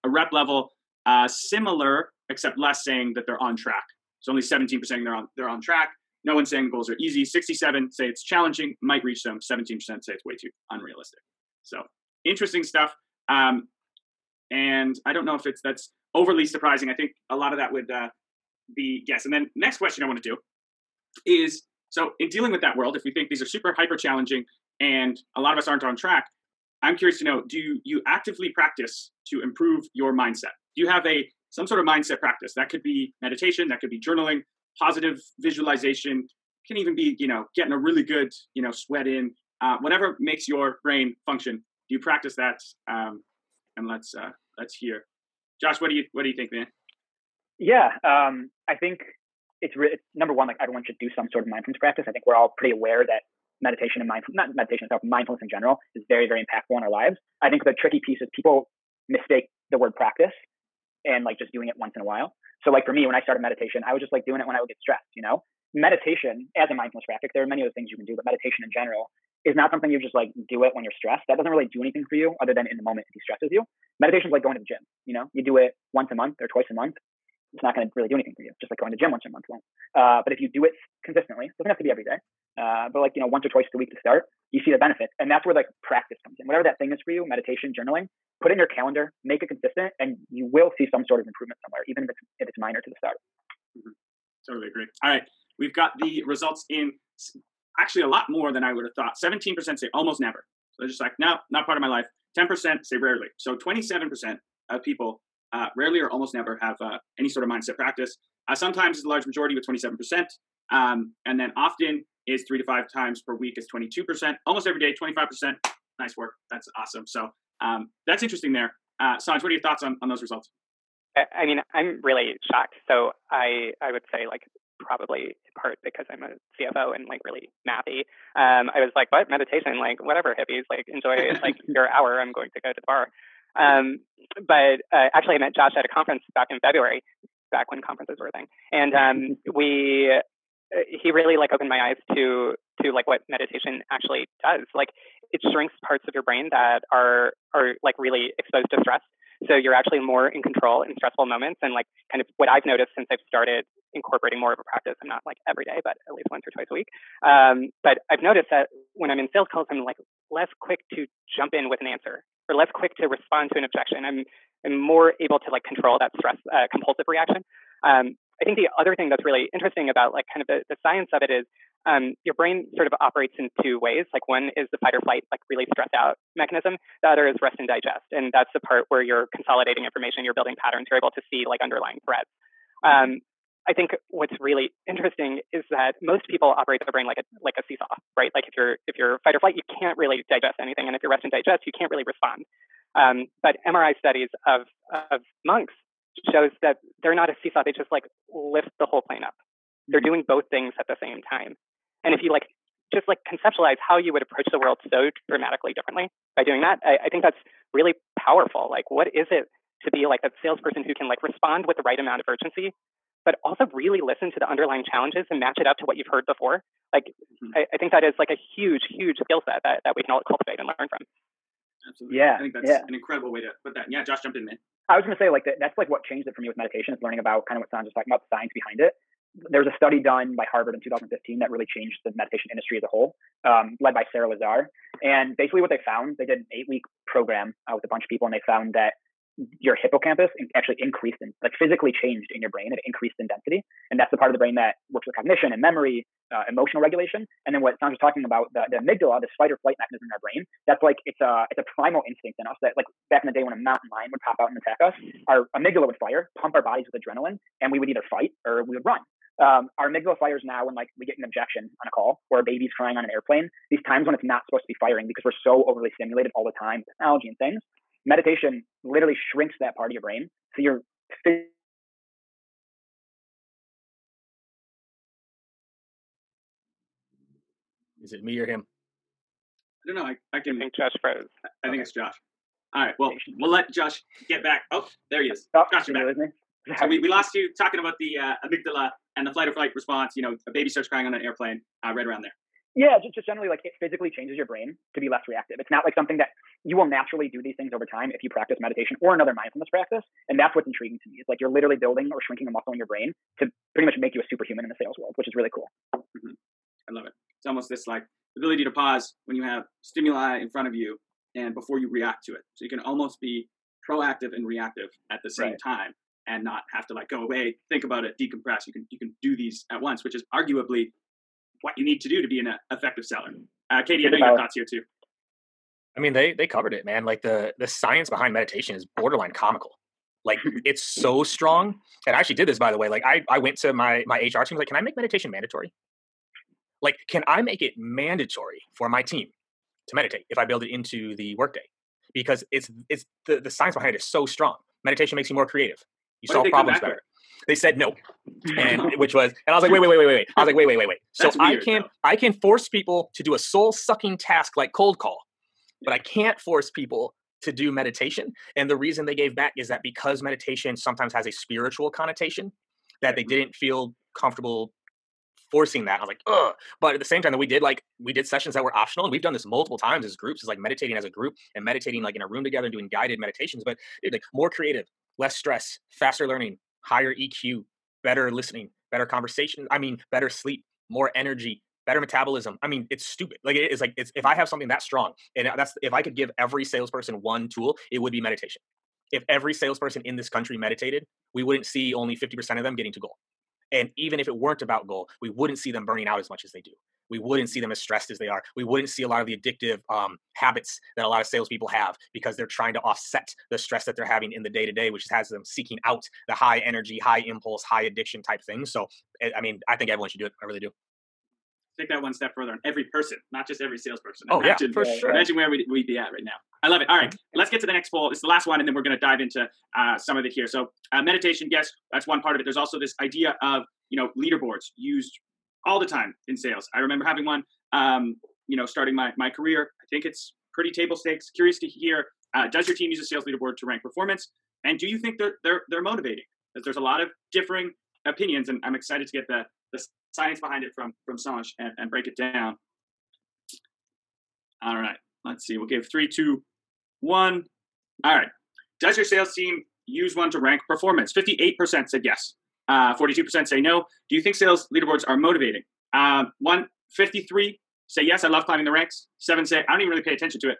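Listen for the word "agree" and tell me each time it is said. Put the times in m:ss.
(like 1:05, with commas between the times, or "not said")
1:34.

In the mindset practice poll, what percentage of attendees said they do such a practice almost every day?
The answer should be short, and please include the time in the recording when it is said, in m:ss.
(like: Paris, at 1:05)
25%, at 1:54.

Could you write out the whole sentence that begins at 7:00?
So, uh, meditation, yes, that's one part of it.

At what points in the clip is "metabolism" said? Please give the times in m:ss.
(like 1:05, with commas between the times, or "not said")
6:21.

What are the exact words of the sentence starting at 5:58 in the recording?
And the reason they gave back is that because meditation sometimes has a spiritual connotation, that they didn't feel comfortable forcing that.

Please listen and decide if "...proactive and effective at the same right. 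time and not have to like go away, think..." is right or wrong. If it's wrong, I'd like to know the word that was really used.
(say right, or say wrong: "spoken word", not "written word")
wrong: "reactive", not "effective".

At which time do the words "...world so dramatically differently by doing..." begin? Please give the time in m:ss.
3:24.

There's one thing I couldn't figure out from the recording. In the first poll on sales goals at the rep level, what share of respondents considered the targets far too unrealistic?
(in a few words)
17%.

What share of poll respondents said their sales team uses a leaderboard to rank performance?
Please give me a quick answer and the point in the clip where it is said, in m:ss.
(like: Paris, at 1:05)
58%, at 7:31.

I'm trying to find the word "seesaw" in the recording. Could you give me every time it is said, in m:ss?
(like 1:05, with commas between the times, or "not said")
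3:07, 3:17.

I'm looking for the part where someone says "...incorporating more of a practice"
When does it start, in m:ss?
2:33.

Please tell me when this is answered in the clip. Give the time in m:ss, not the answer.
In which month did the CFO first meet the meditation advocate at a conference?
2:16.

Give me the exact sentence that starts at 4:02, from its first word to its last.
It increased in density, and that's the part of the brain that works with cognition and memory, uh, emotional regulation.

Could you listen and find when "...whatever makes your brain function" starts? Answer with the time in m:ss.
0:39.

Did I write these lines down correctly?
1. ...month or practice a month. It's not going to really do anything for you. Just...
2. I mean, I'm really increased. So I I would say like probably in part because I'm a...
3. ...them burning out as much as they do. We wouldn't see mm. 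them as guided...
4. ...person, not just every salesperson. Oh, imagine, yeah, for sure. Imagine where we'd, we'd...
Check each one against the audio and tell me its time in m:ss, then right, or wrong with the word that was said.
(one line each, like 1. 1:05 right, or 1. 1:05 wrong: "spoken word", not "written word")
1. 1:16 wrong: "twice", not "practice"
2. 2:01 wrong: "shocked", not "increased"
3. 6:35 wrong: "stressed", not "guided"
4. 6:52 right.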